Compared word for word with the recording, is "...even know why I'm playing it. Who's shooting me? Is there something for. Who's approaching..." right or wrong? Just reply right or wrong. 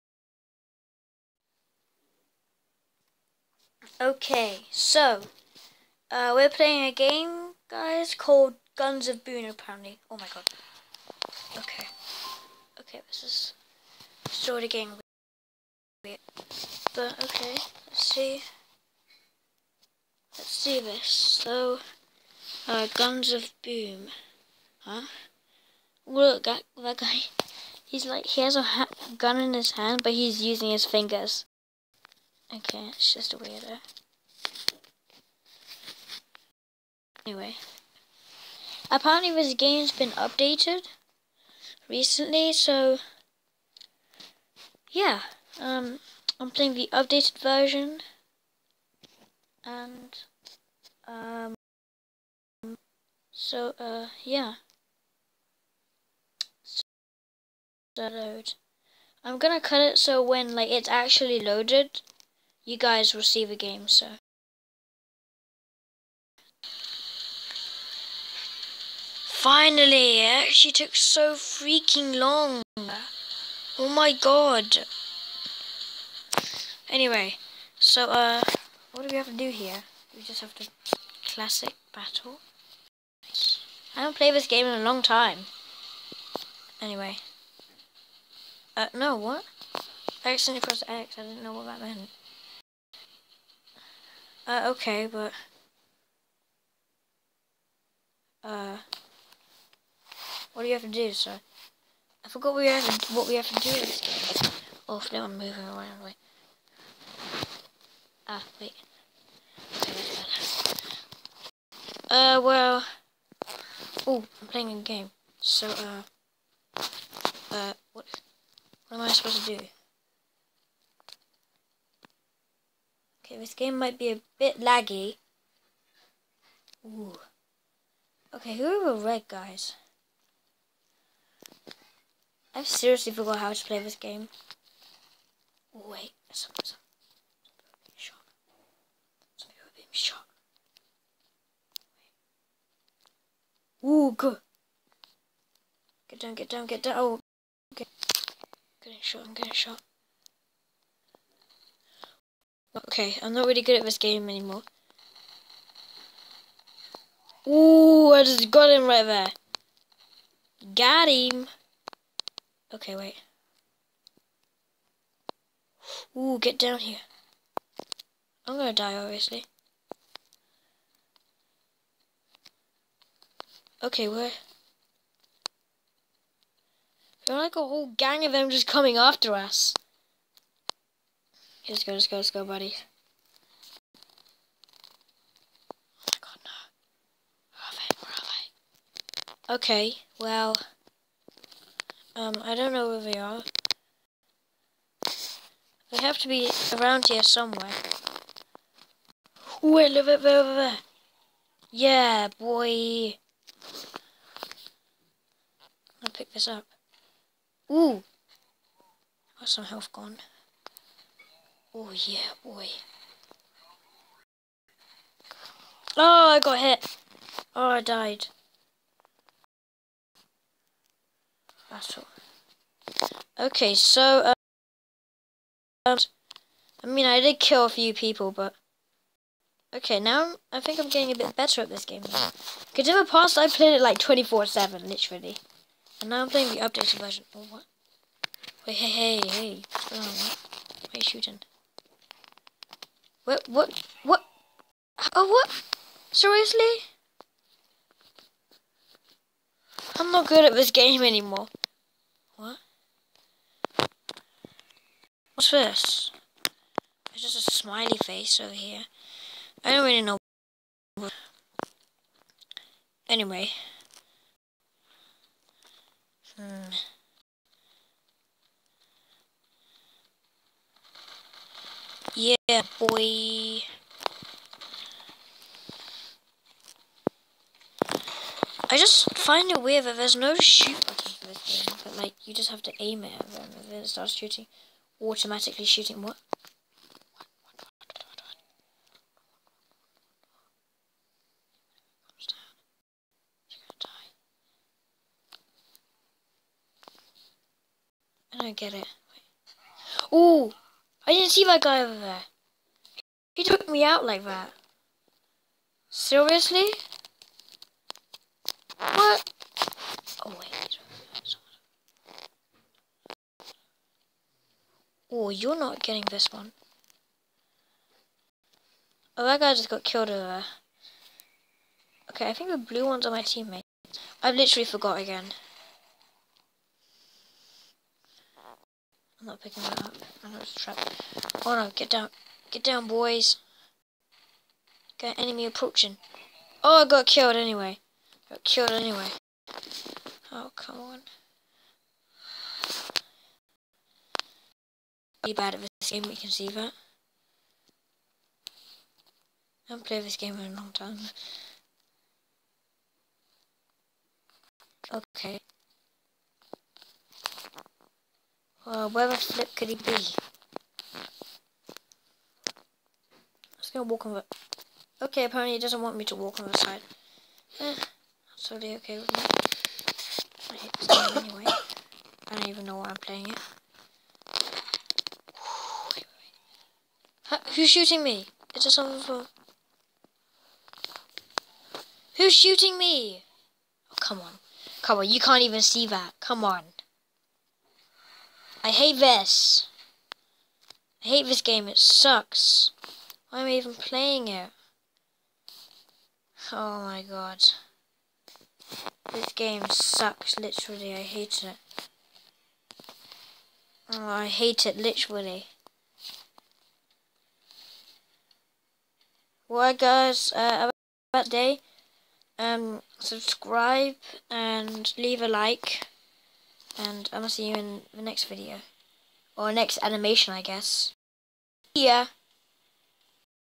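wrong.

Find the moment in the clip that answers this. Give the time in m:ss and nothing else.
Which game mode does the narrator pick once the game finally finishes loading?
1:21.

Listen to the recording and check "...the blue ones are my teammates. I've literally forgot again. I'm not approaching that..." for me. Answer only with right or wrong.
wrong.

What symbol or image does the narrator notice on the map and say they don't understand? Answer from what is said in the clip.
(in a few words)
Smiley face.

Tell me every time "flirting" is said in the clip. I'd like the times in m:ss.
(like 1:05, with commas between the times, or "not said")
not said.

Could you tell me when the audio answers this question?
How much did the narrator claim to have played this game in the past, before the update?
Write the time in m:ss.
3:53.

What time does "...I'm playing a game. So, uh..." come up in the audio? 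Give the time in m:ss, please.
1:54.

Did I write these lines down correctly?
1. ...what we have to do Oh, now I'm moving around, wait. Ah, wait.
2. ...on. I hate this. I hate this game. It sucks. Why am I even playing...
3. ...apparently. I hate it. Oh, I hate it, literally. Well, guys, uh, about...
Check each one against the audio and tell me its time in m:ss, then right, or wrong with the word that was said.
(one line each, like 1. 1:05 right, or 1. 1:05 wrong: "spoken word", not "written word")
1. 1:43 right
2. 6:26 right
3. 6:40 wrong: "literally", not "apparently".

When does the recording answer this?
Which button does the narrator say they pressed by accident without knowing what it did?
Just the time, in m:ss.
1:30.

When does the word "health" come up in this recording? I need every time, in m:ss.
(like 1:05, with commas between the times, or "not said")
3:29.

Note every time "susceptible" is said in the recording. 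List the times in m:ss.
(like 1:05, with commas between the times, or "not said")
not said.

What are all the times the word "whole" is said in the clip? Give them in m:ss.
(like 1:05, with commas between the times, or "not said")
2:57.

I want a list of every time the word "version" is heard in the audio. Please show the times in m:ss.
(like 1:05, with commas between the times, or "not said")
0:47, 3:56.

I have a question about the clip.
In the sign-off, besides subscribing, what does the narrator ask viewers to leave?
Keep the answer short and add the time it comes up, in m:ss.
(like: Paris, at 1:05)
A like, at 6:55.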